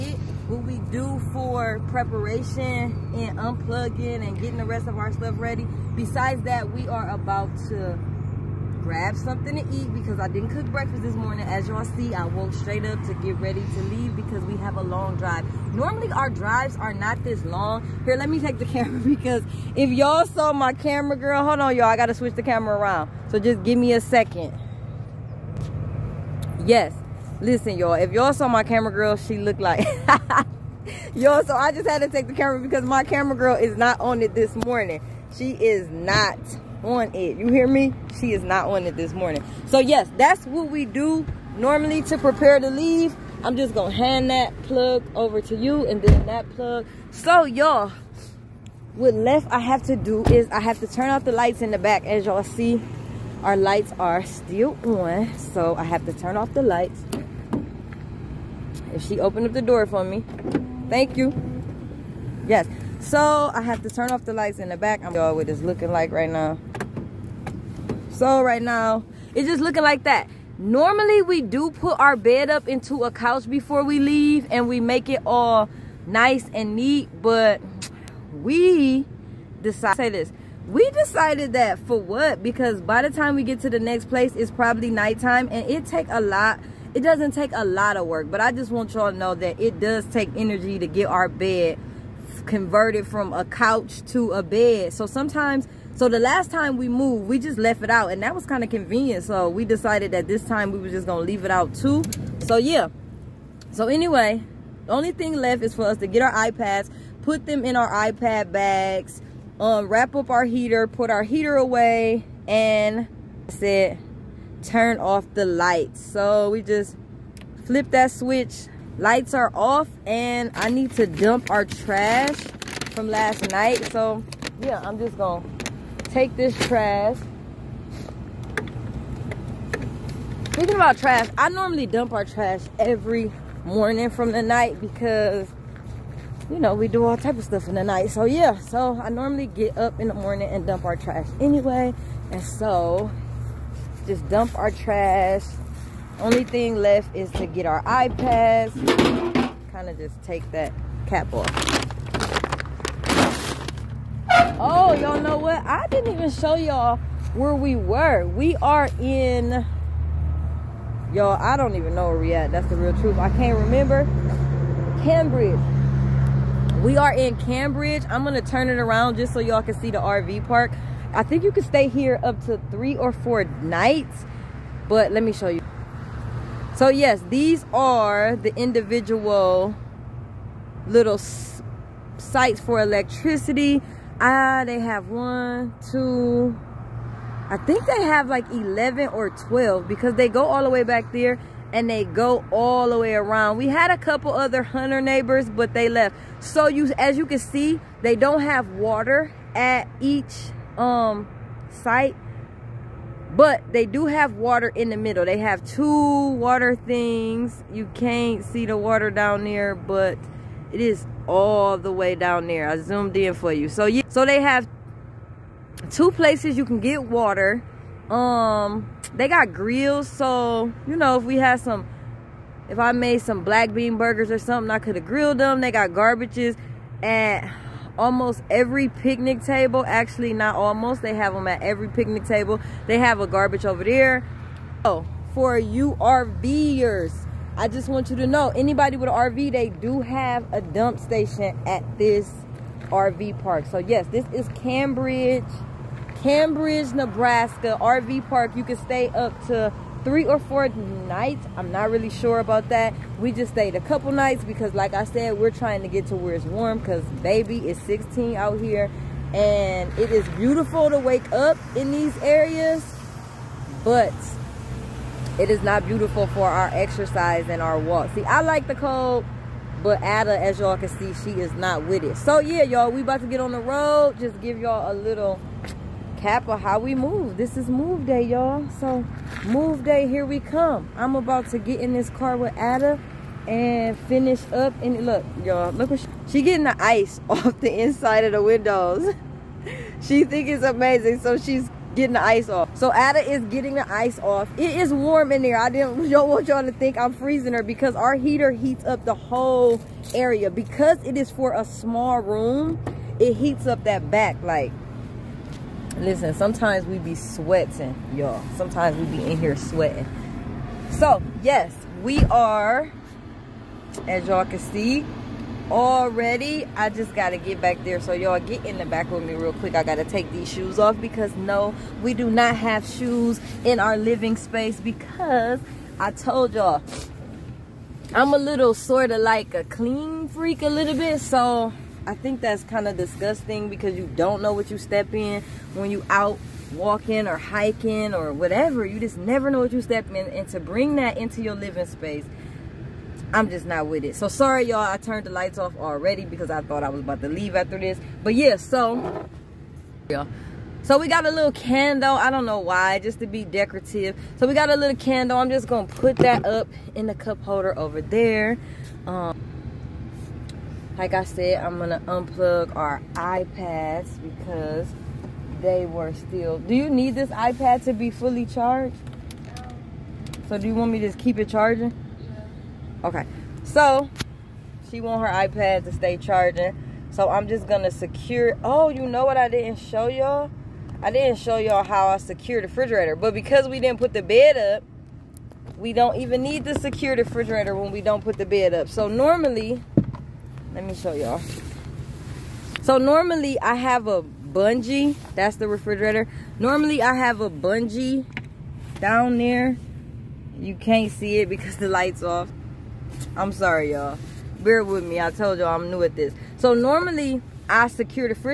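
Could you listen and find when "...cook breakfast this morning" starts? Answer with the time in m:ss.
0:10.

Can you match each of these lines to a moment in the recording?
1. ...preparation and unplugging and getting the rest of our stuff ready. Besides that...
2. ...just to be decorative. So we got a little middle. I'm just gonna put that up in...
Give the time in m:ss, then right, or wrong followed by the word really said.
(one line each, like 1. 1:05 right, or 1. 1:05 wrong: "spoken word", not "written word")
1. 0:01 right
2. 5:52 wrong: "candle", not "middle".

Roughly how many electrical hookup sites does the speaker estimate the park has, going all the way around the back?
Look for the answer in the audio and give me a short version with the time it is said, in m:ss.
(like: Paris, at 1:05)
11 or 12, at 3:08.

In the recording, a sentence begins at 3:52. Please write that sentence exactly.
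They have a garbage over there.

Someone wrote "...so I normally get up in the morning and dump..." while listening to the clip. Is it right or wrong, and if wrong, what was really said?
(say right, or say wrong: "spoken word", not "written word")
right.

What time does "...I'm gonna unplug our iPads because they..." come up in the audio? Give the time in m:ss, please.
6:01.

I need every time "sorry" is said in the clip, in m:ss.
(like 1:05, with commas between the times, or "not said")
5:44, 6:43.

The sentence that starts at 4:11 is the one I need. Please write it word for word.
I'm not really sure about that.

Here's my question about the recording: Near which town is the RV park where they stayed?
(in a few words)
Cambridge, Nebraska.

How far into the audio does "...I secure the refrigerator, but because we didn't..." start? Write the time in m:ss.
6:22.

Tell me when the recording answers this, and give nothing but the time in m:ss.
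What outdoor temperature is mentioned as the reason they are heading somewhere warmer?
4:17.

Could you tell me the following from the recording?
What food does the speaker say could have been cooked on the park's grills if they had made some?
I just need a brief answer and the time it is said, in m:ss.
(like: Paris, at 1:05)
Black bean burgers, at 3:43.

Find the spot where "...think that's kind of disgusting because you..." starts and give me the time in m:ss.
5:32.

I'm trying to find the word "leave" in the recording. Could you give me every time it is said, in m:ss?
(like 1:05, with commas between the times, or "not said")
0:13, 0:42, 1:14, 1:41, 5:47.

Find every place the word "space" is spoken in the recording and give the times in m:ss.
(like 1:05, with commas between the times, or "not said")
5:24, 5:41.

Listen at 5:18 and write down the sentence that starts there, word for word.
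So y'all get in the back with me real quick.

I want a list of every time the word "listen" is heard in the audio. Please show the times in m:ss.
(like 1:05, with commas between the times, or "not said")
0:27, 5:05.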